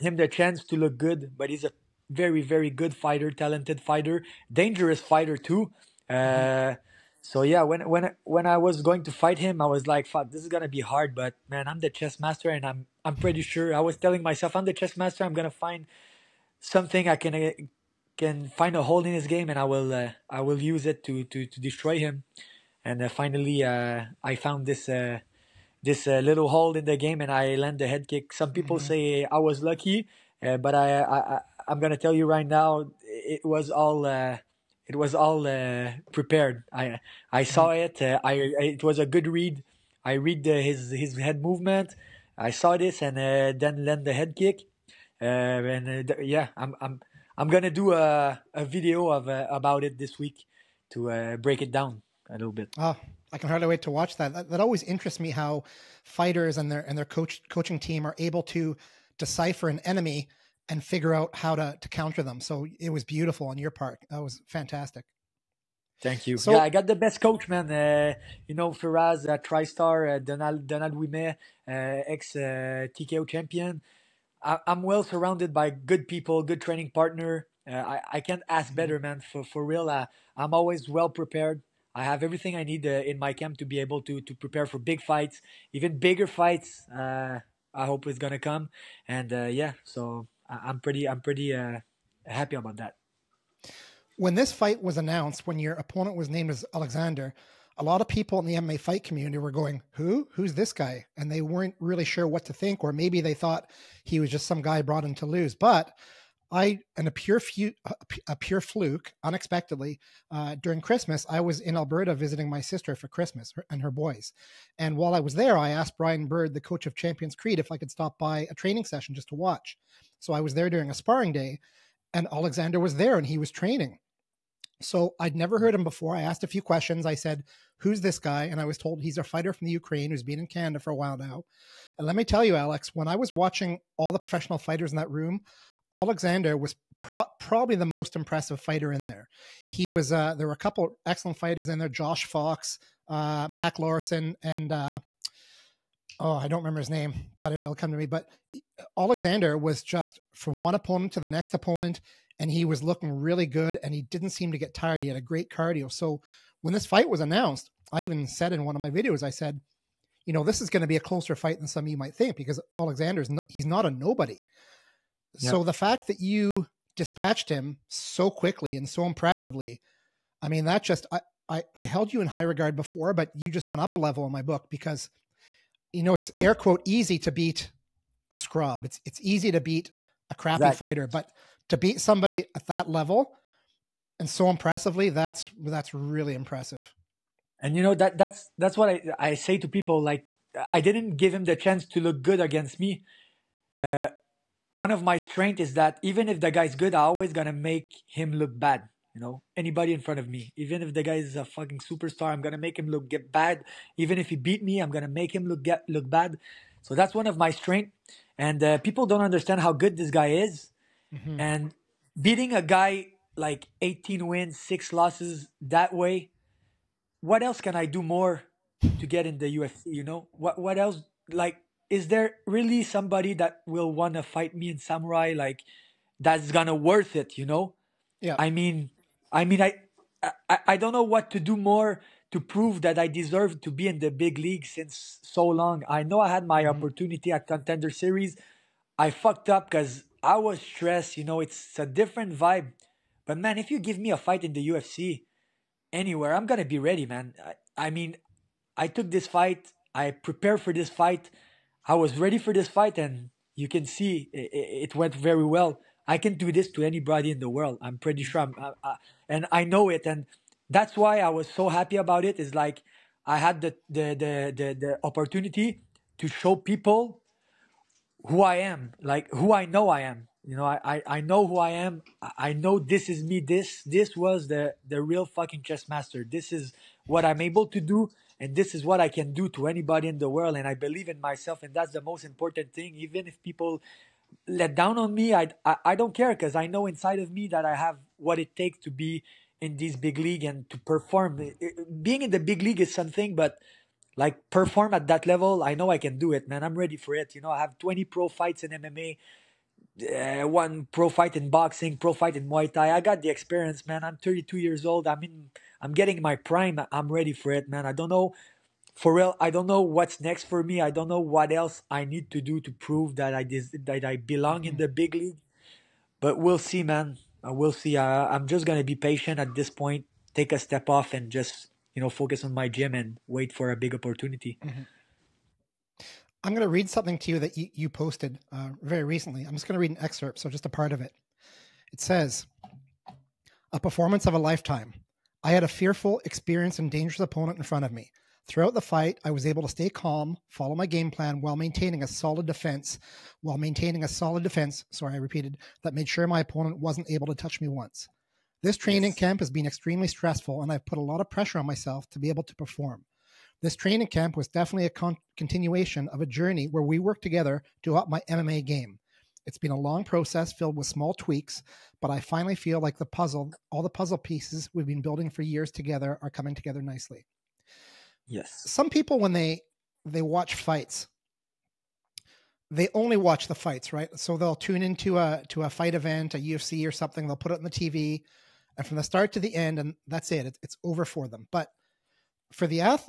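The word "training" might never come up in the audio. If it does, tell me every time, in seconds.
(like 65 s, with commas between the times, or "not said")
76 s, 118 s, 123 s, 348 s, 353 s.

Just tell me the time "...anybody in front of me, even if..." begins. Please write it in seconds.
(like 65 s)
199 s.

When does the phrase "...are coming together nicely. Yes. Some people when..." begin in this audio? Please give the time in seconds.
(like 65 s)
366 s.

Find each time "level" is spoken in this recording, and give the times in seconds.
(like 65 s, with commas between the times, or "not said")
173 s, 182 s, 295 s.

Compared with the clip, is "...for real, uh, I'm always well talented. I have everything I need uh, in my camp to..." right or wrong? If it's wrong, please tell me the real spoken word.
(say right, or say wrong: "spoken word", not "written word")
wrong: "prepared", not "talented".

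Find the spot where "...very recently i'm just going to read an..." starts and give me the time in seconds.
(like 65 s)
328 s.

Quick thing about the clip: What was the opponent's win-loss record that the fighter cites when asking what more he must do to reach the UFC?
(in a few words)
18 wins, 6 losses.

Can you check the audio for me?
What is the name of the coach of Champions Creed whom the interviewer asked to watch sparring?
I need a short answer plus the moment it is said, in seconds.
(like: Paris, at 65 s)
Brian Bird, at 115 s.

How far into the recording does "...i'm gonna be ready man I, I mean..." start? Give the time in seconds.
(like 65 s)
246 s.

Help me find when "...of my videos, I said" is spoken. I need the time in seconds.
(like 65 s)
158 s.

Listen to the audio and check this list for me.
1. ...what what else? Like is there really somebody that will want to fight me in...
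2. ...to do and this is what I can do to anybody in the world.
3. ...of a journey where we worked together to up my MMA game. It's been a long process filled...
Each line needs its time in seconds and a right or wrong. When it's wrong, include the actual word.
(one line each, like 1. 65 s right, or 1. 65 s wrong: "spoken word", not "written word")
1. 220 s right
2. 277 s right
3. 356 s right.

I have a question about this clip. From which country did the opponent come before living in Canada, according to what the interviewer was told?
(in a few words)
Ukraine.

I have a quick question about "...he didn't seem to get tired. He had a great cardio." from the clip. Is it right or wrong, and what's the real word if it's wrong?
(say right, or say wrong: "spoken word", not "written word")
right.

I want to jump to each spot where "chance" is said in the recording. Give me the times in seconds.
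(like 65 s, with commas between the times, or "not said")
0 s, 191 s.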